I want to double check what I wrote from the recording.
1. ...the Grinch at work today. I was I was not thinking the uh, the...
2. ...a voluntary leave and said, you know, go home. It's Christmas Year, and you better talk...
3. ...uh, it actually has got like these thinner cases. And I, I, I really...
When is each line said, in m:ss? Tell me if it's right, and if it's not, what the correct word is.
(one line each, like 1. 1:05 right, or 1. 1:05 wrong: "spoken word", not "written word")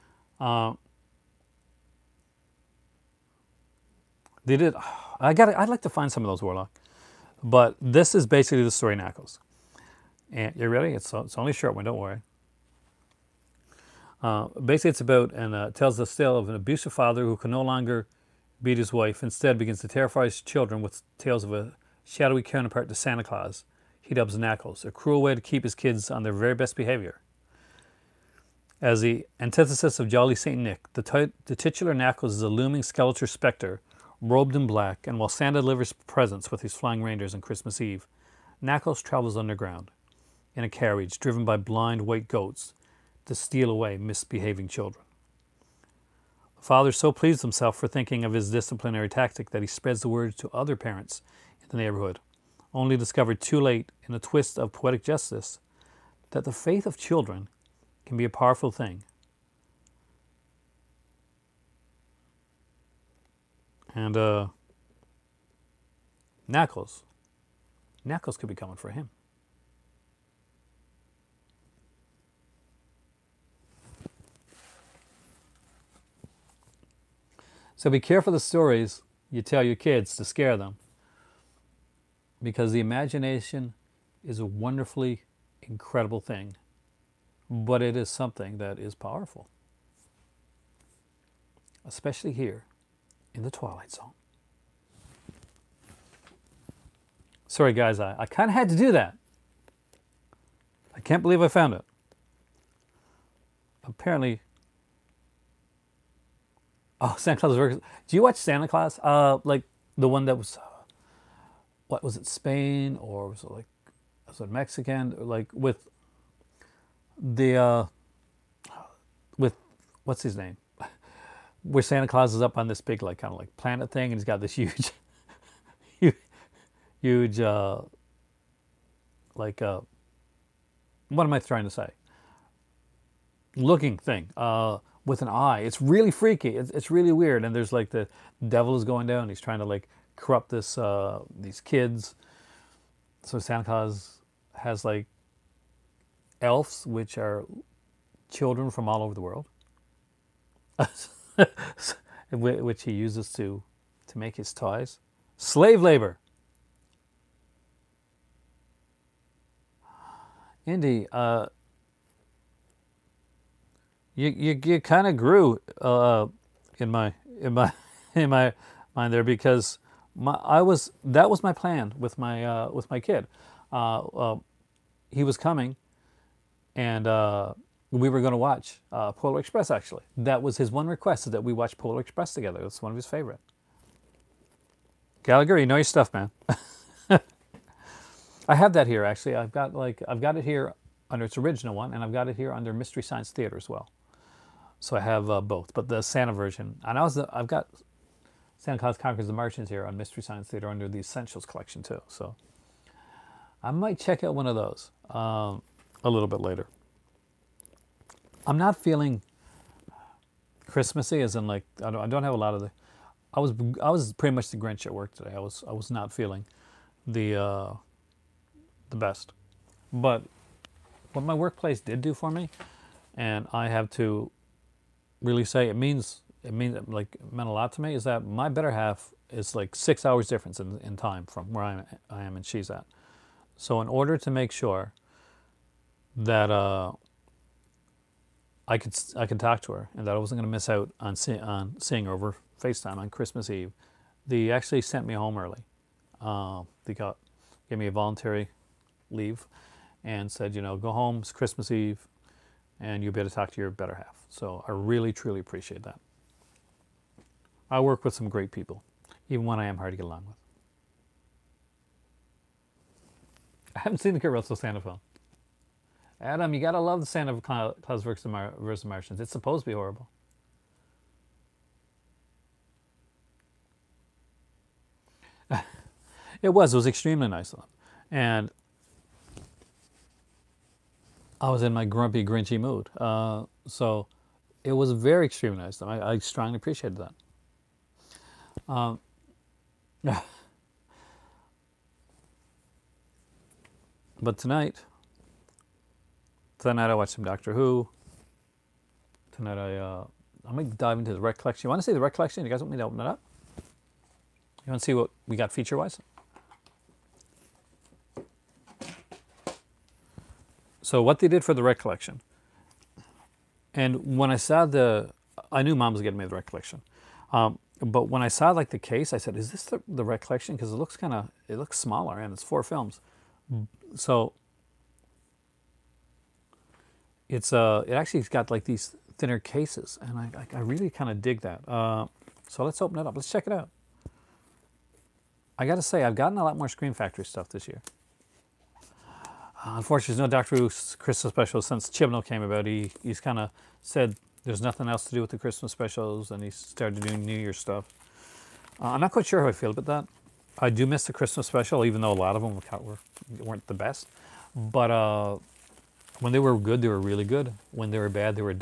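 1. 3:34 wrong: "feeling", not "thinking"
2. 4:07 wrong: "Eve", not "Year"
3. 5:27 right.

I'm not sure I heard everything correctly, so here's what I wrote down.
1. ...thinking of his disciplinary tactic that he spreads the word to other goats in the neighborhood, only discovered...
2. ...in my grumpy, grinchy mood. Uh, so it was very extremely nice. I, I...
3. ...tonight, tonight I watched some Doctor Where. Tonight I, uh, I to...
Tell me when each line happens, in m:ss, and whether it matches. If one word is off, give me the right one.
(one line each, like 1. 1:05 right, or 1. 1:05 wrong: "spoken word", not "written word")
1. 0:47 wrong: "parents", not "goats"
2. 4:41 right
3. 4:54 wrong: "Who", not "Where".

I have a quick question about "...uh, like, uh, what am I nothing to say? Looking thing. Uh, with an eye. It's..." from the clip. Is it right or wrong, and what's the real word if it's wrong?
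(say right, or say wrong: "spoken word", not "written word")
wrong: "trying", not "nothing".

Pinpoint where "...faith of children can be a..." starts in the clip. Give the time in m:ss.
0:56.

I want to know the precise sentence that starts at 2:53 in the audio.
Uh, uh he was coming, and uh, we were going to watch uh, Polar Express.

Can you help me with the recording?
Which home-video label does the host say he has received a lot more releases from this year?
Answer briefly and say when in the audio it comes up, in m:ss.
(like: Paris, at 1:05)
Scream Factory, at 5:36.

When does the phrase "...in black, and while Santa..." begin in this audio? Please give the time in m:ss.
0:34.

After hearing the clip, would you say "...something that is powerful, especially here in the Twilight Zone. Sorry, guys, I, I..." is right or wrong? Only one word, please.
right.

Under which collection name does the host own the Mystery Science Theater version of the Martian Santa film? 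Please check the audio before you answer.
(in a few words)
Essentials collection.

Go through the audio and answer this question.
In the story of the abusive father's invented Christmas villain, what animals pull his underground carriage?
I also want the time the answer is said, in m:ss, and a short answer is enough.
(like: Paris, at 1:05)
blind white goats, at 0:41.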